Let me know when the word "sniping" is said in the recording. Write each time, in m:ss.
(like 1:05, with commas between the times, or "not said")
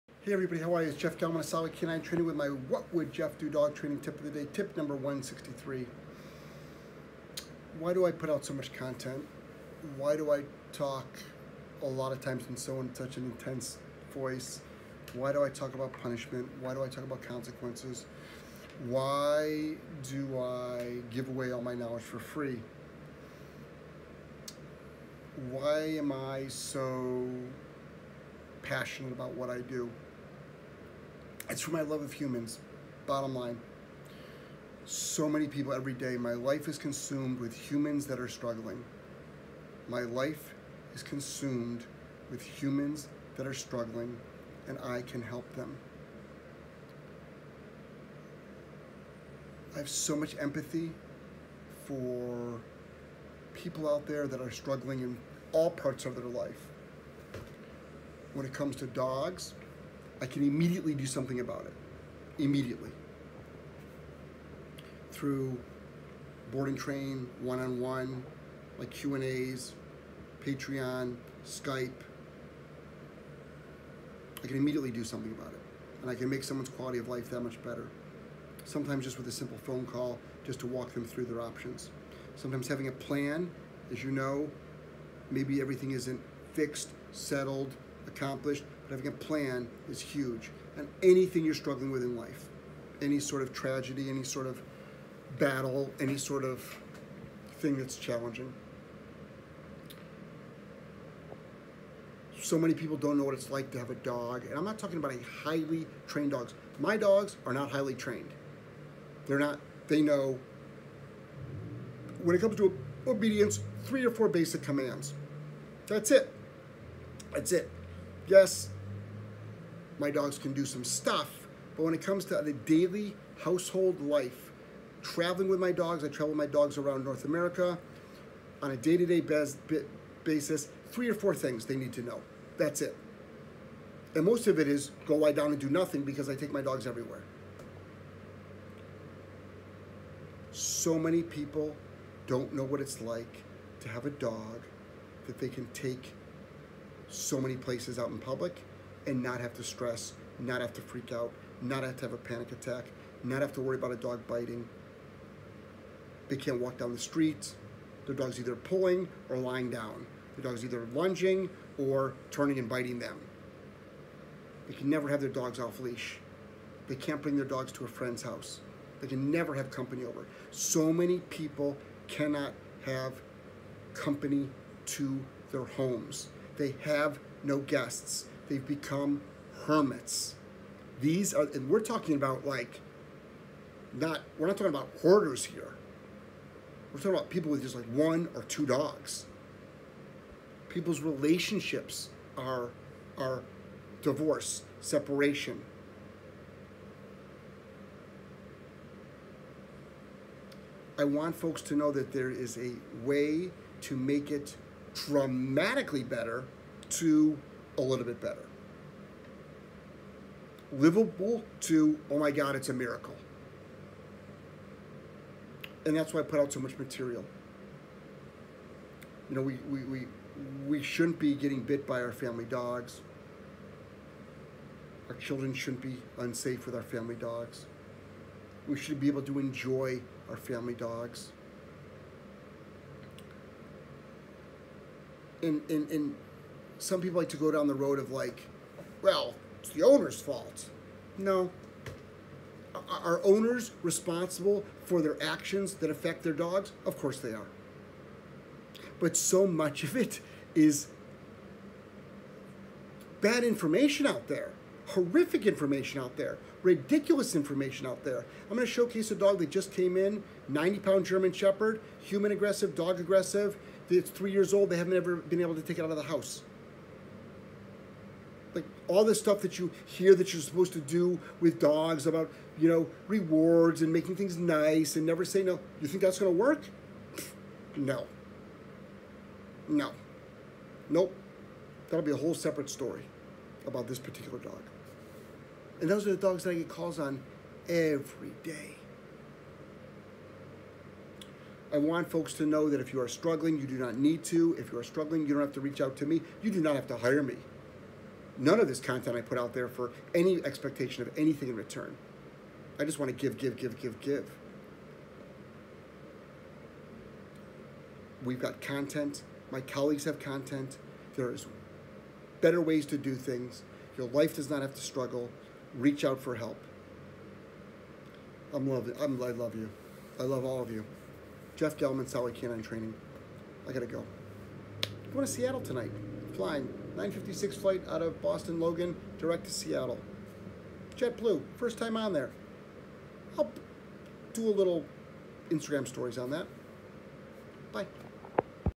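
not said.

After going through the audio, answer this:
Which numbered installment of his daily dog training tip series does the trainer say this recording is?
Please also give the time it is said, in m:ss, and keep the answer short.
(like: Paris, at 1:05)
163, at 0:04.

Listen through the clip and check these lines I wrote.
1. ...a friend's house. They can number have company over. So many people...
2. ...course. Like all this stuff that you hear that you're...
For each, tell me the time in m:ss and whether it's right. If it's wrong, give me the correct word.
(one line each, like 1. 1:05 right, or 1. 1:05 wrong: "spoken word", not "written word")
1. 2:47 wrong: "never", not "number"
2. 4:26 wrong: "house", not "course".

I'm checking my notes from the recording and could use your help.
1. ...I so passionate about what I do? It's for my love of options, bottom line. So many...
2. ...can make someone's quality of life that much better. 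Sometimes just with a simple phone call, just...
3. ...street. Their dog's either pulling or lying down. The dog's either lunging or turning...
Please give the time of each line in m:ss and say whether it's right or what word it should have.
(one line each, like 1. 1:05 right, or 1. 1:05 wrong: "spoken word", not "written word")
1. 0:26 wrong: "humans", not "options"
2. 1:16 right
3. 2:36 right.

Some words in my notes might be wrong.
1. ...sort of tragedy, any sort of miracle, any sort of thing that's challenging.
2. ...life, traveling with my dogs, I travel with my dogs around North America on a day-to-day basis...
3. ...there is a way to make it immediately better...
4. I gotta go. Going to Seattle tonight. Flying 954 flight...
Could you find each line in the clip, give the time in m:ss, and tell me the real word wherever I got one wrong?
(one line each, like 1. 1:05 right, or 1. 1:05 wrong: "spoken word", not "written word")
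1. 1:33 wrong: "battle", not "miracle"
2. 2:04 right
3. 3:22 wrong: "dramatically", not "immediately"
4. 5:23 wrong: "956", not "954".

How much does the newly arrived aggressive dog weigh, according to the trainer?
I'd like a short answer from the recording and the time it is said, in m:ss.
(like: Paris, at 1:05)
90 pounds, at 4:20.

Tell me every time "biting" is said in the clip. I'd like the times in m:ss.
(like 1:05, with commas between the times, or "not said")
2:34, 2:42.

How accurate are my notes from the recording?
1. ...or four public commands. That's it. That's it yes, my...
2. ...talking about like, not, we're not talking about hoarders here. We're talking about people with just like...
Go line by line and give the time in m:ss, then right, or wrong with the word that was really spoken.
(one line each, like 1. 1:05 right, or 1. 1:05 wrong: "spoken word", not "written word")
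1. 1:54 wrong: "basic", not "public"
2. 3:01 right.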